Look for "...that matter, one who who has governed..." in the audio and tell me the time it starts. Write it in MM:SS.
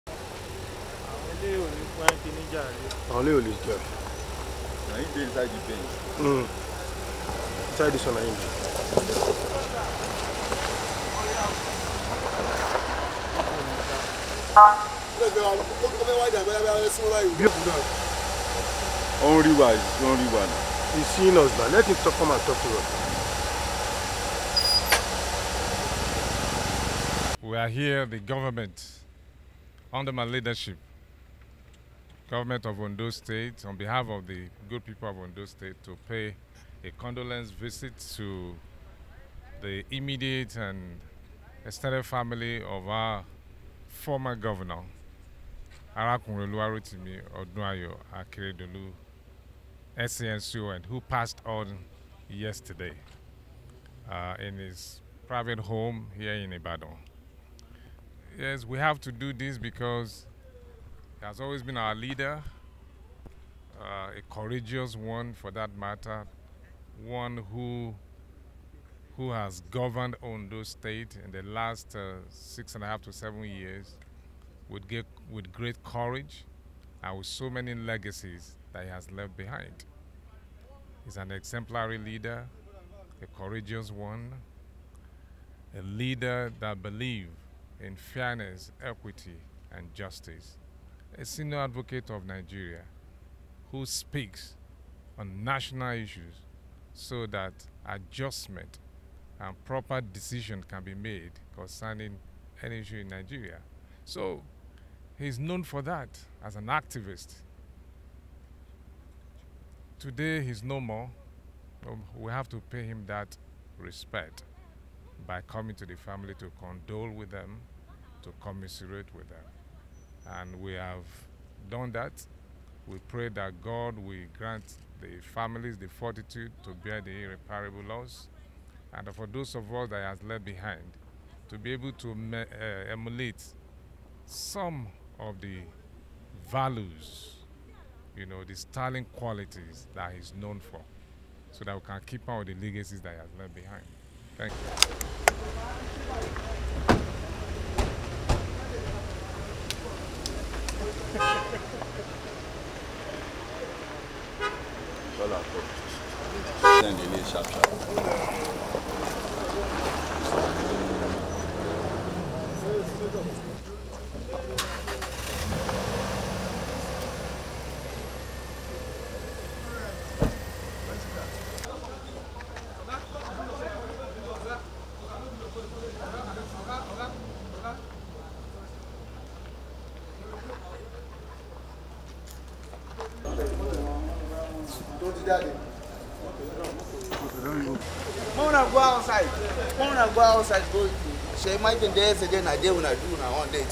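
01:05.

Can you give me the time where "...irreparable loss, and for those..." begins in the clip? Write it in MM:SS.
02:07.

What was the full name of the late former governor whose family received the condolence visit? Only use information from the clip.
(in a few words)
Oluwarotimi Odunayo Akeredolu.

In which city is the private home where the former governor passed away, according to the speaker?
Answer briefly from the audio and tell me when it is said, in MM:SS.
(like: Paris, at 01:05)
Ibadan, at 00:56.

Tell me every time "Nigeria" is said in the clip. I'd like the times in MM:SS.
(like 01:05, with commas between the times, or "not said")
01:32, 01:43.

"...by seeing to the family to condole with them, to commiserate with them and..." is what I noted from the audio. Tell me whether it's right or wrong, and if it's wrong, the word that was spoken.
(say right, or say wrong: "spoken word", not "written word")
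wrong: "coming", not "seeing".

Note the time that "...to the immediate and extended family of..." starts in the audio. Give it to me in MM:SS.
00:38.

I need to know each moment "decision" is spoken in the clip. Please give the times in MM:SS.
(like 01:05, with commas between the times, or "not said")
01:40.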